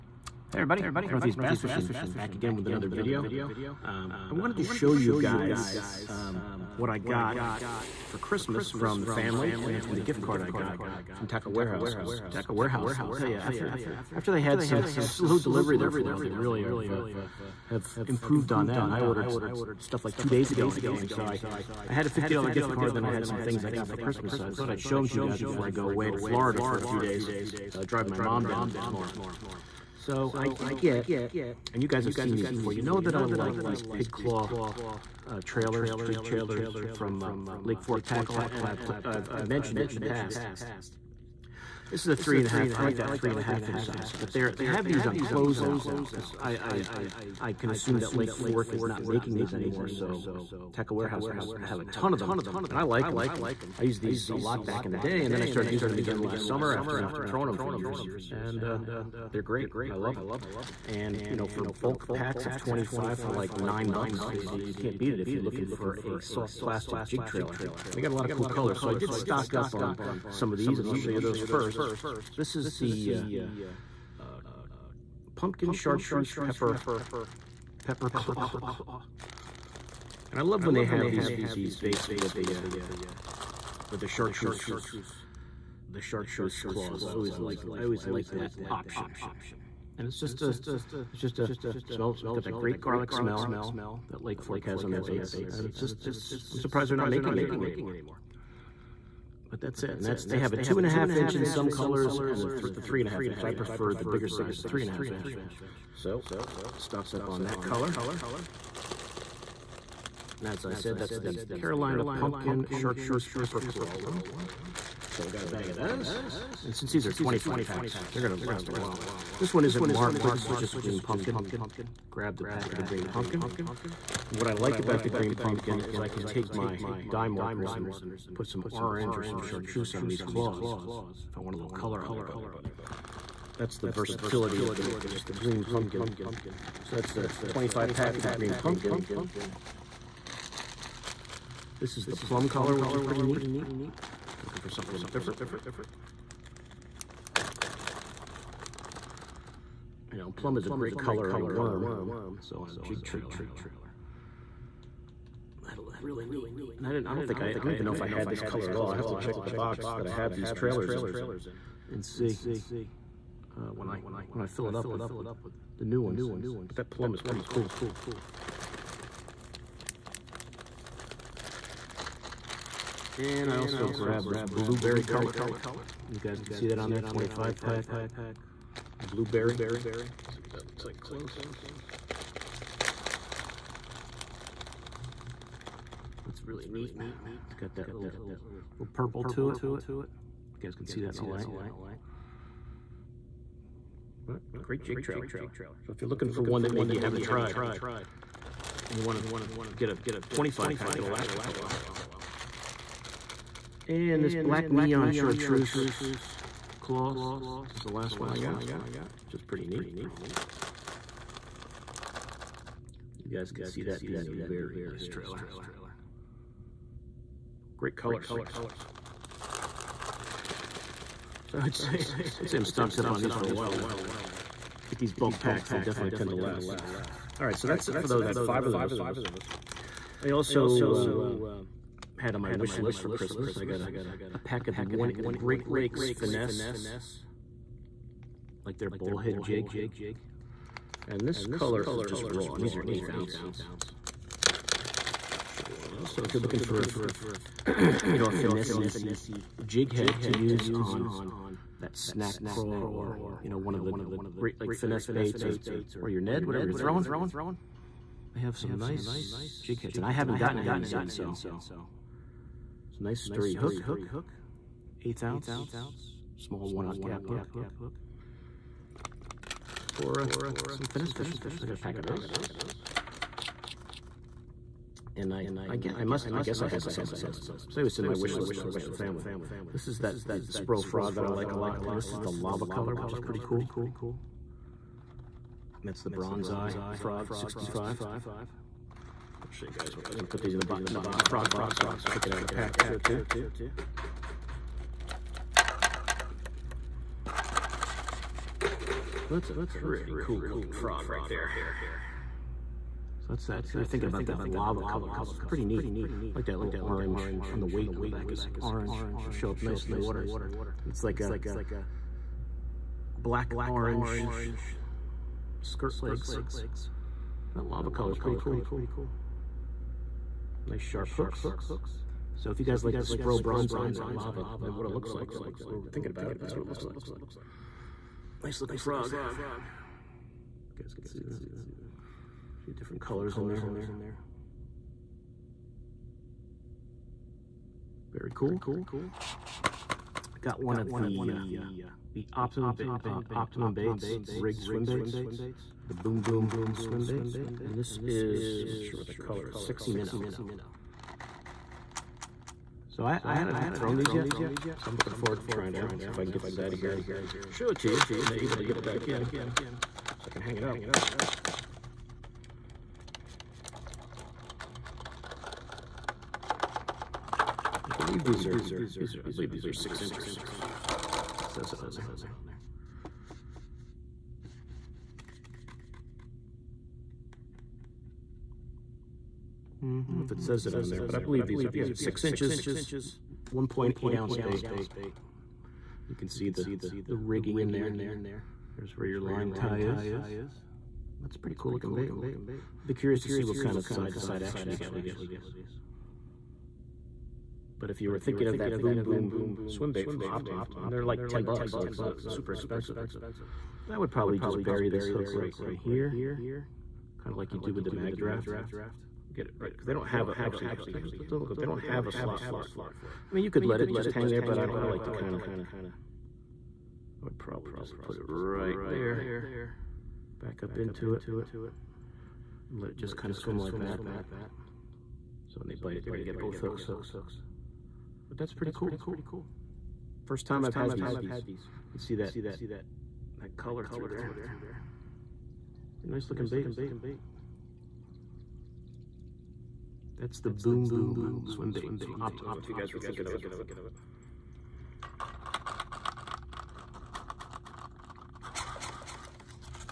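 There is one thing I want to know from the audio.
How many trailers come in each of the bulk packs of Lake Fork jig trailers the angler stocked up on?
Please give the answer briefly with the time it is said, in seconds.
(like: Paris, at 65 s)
25, at 61 s.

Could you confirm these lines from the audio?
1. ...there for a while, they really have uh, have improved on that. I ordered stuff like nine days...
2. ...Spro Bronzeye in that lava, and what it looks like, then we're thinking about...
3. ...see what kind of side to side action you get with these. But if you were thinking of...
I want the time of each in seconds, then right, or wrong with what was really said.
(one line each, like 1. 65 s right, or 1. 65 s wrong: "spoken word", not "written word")
1. 15 s wrong: "two", not "nine"
2. 323 s right
3. 393 s right.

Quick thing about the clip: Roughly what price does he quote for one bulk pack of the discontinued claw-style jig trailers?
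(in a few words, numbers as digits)
$9.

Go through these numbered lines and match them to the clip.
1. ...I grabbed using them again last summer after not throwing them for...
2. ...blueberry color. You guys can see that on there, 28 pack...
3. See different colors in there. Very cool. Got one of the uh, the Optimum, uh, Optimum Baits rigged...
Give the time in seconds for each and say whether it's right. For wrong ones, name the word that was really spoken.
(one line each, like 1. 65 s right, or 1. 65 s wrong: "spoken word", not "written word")
1. 55 s wrong: "started", not "grabbed"
2. 174 s wrong: "25", not "28"
3. 332 s right.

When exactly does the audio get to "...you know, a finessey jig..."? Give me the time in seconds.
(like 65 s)
248 s.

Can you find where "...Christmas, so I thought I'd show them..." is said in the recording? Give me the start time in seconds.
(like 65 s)
23 s.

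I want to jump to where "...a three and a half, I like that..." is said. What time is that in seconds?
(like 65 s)
42 s.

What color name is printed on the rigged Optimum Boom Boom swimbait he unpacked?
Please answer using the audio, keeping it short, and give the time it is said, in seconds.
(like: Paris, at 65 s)
Sexy Minnow, at 349 s.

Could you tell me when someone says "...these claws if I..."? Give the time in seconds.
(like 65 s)
130 s.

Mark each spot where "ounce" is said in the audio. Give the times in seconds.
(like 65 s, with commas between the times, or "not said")
243 s, 265 s, 384 s.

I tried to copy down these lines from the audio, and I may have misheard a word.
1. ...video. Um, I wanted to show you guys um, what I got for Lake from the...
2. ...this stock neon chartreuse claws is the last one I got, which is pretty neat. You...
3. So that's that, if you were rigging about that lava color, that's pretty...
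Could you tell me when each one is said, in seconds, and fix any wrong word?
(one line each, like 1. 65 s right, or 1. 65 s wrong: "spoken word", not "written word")
1. 2 s wrong: "Christmas", not "Lake"
2. 204 s wrong: "black", not "stock"
3. 303 s wrong: "thinking", not "rigging".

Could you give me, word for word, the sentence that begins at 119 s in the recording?
This one isn't marked, but this is just green pumpkin.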